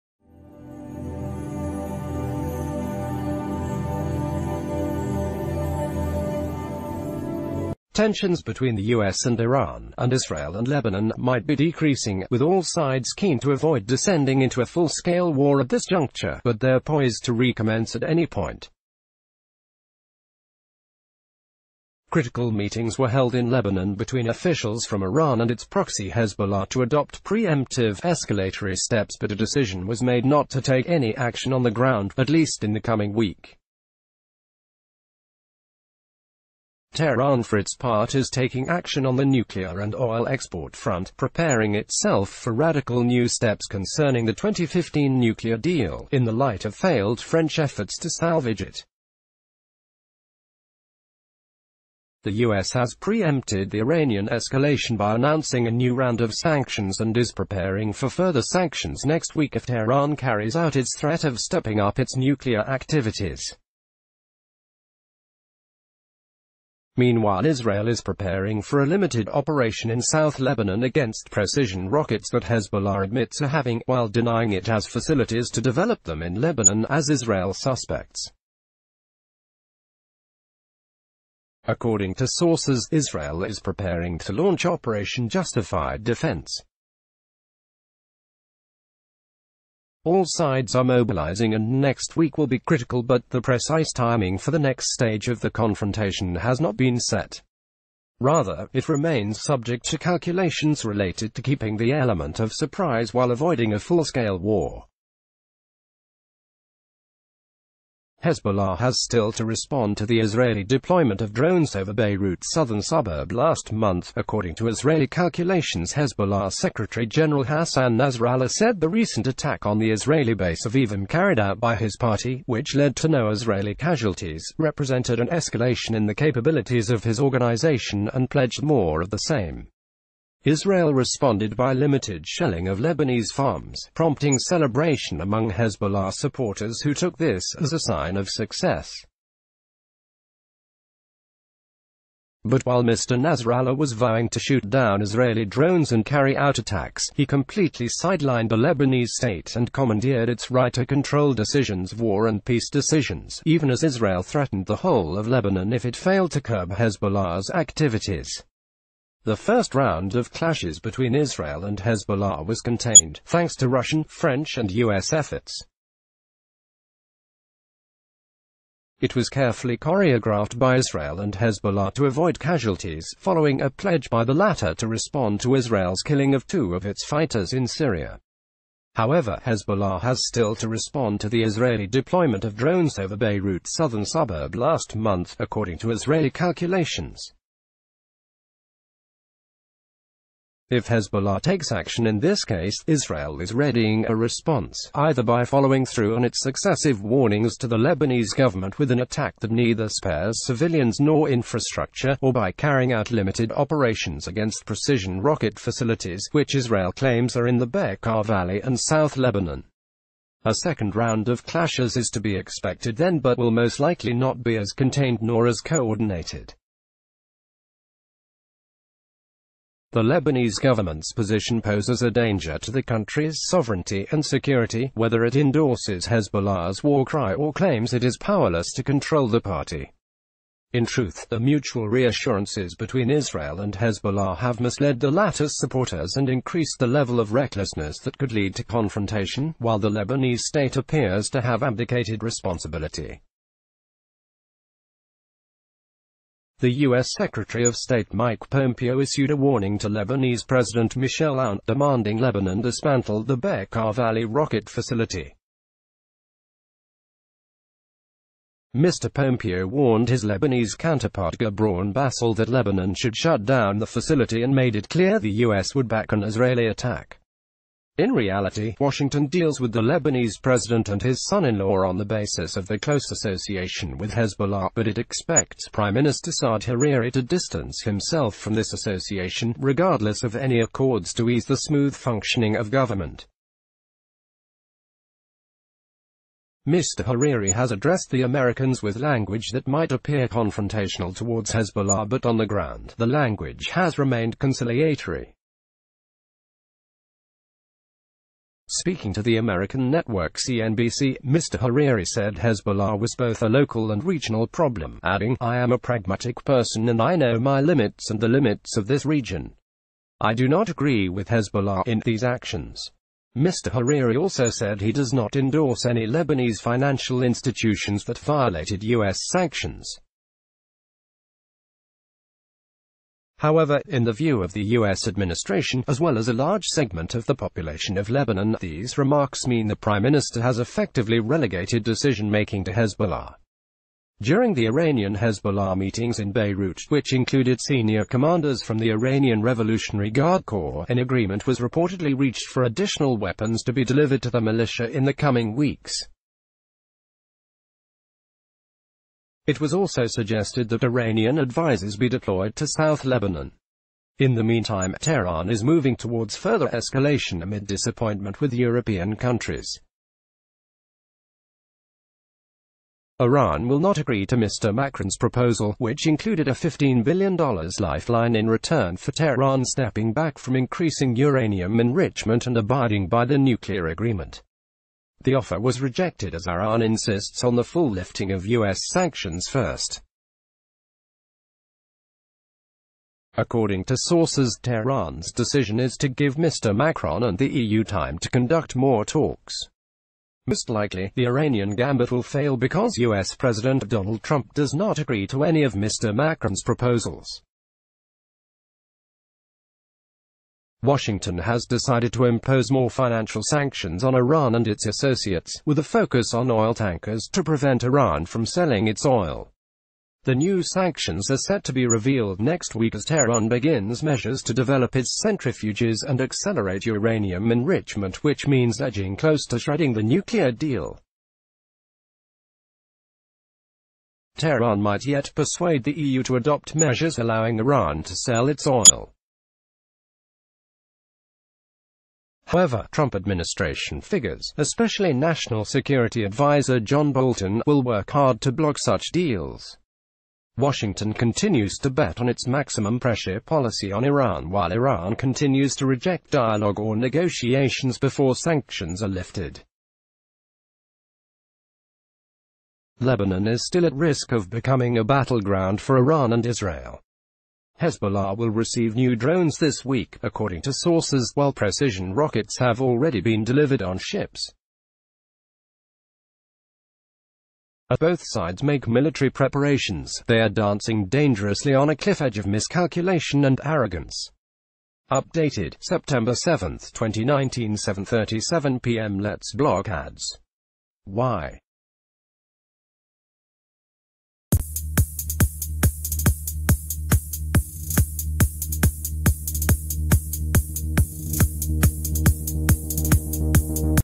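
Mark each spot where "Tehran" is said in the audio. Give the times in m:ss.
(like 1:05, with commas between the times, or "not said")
0:36, 0:59, 5:54, 6:09, 6:24, 6:53, 7:04.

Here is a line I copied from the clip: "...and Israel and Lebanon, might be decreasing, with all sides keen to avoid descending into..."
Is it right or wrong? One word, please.
right.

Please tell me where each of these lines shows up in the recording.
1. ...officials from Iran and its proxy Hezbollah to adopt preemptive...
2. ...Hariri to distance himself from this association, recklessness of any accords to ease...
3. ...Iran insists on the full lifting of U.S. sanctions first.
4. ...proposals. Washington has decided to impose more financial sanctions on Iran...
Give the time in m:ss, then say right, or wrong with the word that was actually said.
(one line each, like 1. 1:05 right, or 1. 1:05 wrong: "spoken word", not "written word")
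1. 0:24 right
2. 4:36 wrong: "regardless", not "recklessness"
3. 6:16 right
4. 6:36 right.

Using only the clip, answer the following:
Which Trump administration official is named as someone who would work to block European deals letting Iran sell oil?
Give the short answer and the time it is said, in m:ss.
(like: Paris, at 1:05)
John Bolton, at 7:16.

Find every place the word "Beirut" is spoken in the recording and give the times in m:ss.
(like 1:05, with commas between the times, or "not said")
1:51, 3:03, 5:36.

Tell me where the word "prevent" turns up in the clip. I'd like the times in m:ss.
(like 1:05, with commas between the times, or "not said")
6:47.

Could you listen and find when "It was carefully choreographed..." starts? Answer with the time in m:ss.
2:48.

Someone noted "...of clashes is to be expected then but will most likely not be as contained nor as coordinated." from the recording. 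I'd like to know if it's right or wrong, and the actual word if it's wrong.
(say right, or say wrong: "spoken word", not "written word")
right.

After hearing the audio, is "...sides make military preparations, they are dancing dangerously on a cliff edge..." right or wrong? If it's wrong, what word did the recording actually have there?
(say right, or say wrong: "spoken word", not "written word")
right.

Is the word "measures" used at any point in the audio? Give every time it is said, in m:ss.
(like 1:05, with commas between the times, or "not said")
6:54, 7:06.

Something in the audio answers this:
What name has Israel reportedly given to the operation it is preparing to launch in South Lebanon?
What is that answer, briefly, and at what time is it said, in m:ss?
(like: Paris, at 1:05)
Operation Justified Defense, at 1:24.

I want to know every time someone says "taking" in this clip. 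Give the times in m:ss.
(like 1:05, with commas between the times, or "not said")
0:38.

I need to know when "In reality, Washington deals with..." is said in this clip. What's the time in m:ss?
4:27.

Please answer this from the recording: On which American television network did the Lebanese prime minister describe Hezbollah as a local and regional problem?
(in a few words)
CNBC.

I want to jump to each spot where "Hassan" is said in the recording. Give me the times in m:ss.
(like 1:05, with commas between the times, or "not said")
1:57.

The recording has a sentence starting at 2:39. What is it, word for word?
The first round of clashes between Israel and Hezbollah was contained, thanks to Russian, French and US efforts.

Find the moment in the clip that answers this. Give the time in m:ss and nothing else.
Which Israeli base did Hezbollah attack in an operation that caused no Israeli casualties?
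2:00.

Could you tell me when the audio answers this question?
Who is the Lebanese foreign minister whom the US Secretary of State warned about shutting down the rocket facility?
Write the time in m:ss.
4:21.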